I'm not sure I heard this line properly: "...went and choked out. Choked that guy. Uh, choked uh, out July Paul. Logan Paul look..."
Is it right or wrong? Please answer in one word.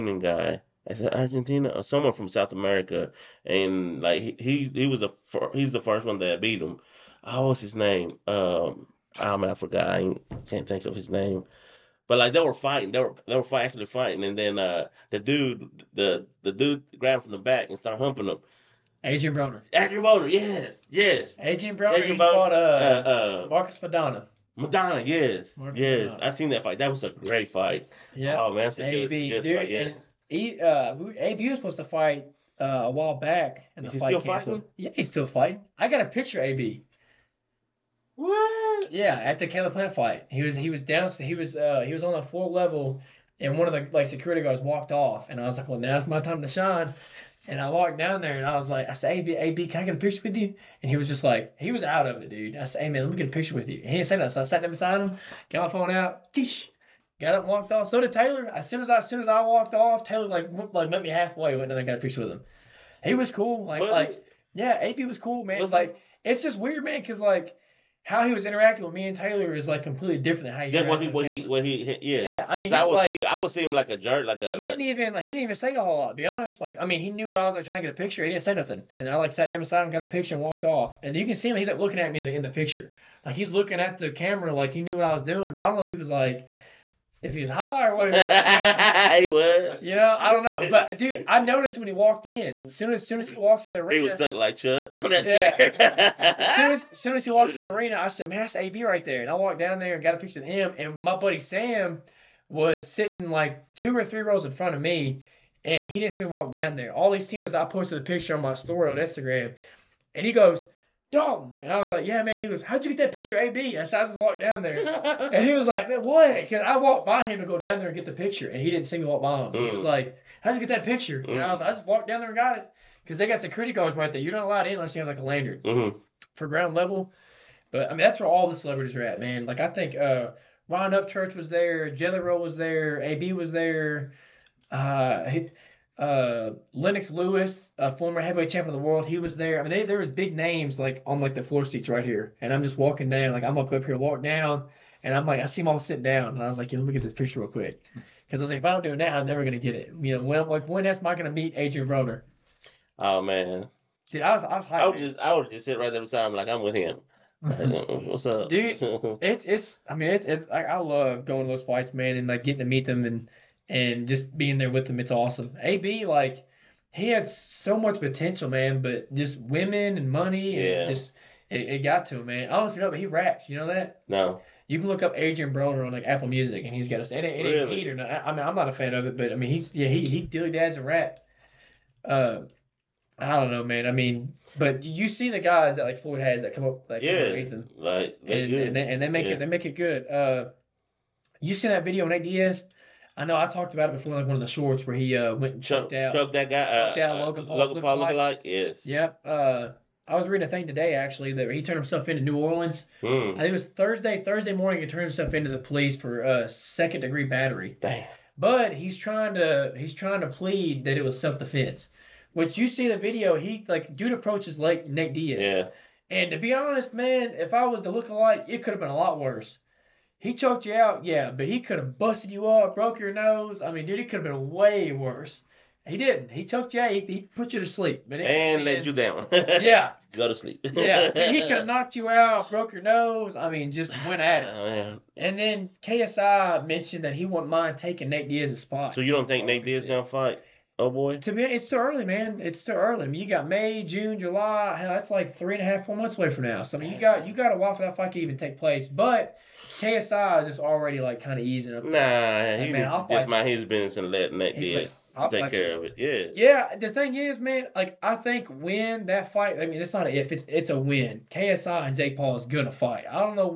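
wrong.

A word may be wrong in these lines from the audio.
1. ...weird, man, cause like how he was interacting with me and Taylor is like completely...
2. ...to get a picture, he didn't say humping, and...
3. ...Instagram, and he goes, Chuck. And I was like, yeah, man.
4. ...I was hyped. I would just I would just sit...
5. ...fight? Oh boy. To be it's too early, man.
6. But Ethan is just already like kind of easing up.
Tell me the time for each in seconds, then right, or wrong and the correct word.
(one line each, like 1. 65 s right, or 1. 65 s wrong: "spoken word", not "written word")
1. 66 s right
2. 77 s wrong: "nothing", not "humping"
3. 108 s wrong: "Dalton", not "Chuck"
4. 154 s right
5. 240 s right
6. 248 s wrong: "KSI", not "Ethan".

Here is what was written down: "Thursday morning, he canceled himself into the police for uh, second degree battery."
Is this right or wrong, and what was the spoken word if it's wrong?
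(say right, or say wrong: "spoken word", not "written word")
wrong: "turned", not "canceled".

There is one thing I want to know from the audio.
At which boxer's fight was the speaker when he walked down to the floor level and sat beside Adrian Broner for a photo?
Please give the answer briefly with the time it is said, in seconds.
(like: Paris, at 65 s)
Caleb Plant, at 39 s.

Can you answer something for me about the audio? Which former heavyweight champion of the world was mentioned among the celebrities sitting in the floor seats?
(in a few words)
Lennox Lewis.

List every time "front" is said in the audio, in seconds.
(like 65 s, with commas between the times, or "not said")
104 s.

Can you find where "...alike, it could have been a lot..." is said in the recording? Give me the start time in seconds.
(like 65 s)
218 s.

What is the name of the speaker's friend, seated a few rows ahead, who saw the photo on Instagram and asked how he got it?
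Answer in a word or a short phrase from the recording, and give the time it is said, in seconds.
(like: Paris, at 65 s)
Sam, at 101 s.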